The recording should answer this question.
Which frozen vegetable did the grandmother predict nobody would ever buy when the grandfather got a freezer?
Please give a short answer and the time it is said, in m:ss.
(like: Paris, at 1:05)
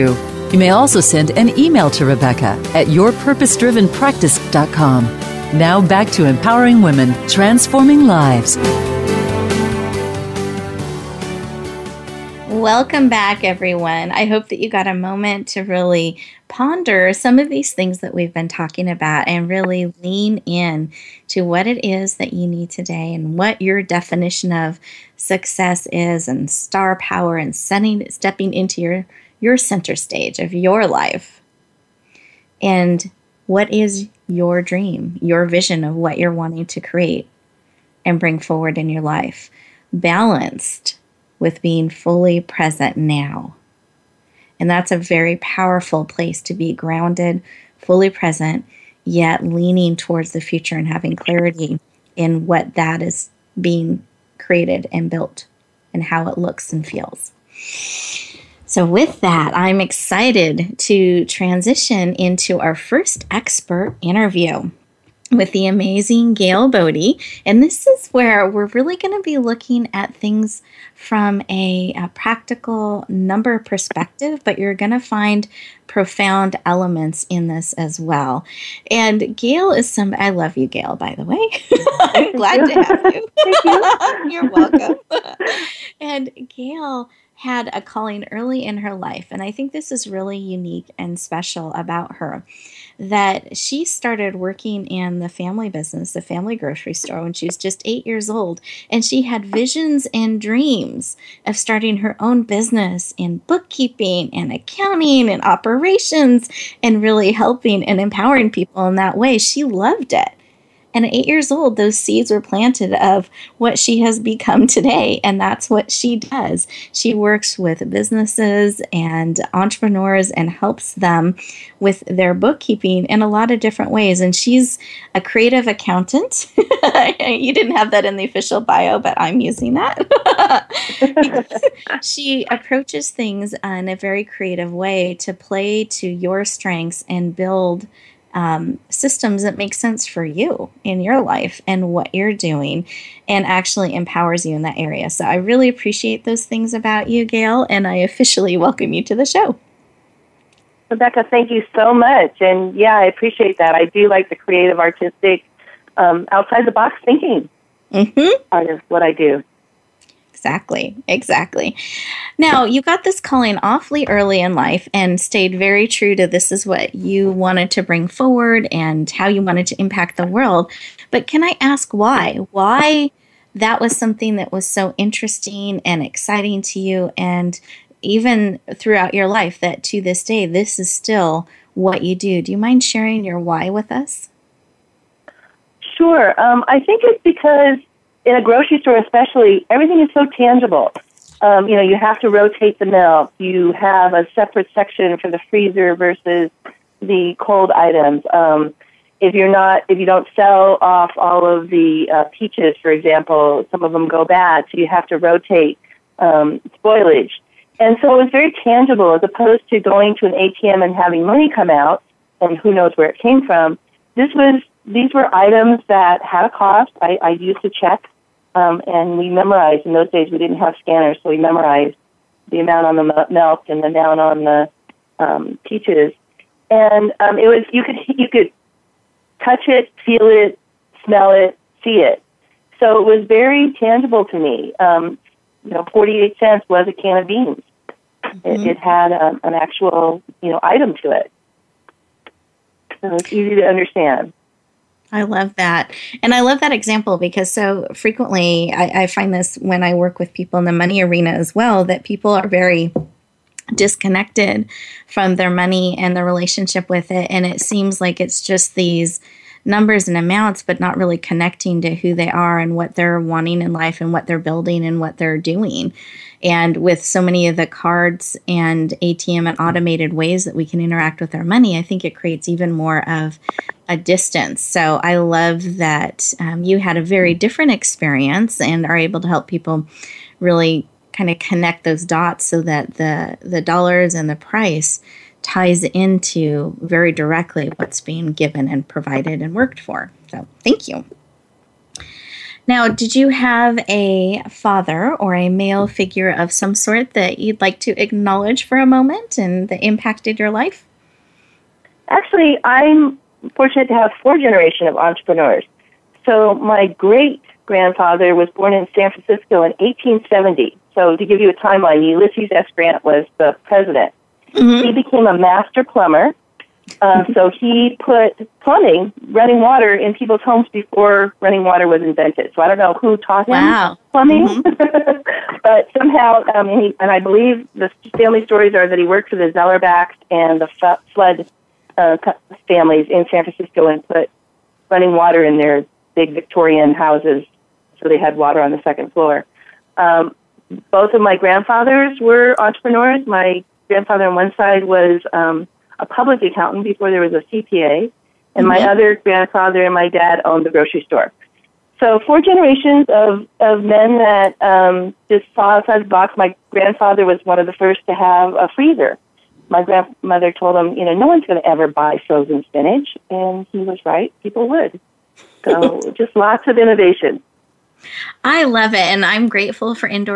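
spinach, at 6:02.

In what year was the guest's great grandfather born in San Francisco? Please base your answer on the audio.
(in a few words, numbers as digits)
1870.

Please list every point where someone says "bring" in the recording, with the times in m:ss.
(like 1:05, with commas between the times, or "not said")
0:38, 2:47.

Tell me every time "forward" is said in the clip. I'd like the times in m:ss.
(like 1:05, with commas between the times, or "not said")
0:38, 2:48.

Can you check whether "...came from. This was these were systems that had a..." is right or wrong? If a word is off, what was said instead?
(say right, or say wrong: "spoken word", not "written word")
wrong: "items", not "systems".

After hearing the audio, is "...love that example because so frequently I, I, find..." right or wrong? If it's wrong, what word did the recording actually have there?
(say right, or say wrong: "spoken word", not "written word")
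right.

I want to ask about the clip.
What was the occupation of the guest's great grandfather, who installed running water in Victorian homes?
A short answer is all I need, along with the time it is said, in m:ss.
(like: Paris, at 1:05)
plumber, at 5:15.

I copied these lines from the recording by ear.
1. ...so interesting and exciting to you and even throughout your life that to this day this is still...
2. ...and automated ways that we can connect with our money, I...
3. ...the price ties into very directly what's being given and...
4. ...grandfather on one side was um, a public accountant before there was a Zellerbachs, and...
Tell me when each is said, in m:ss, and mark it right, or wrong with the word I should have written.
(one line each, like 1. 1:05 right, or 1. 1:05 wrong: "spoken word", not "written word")
1. 2:54 right
2. 4:29 wrong: "interact", not "connect"
3. 4:44 right
4. 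5:43 wrong: "CPA", not "Zellerbachs".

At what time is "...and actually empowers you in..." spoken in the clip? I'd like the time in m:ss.
2:23.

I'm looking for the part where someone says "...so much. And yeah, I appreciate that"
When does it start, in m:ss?
2:31.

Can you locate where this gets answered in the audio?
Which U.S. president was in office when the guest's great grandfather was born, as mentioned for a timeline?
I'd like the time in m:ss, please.
5:12.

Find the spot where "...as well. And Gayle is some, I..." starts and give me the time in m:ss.
1:17.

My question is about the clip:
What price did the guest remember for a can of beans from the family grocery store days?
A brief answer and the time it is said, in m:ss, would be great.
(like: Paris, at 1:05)
48 cents, at 3:55.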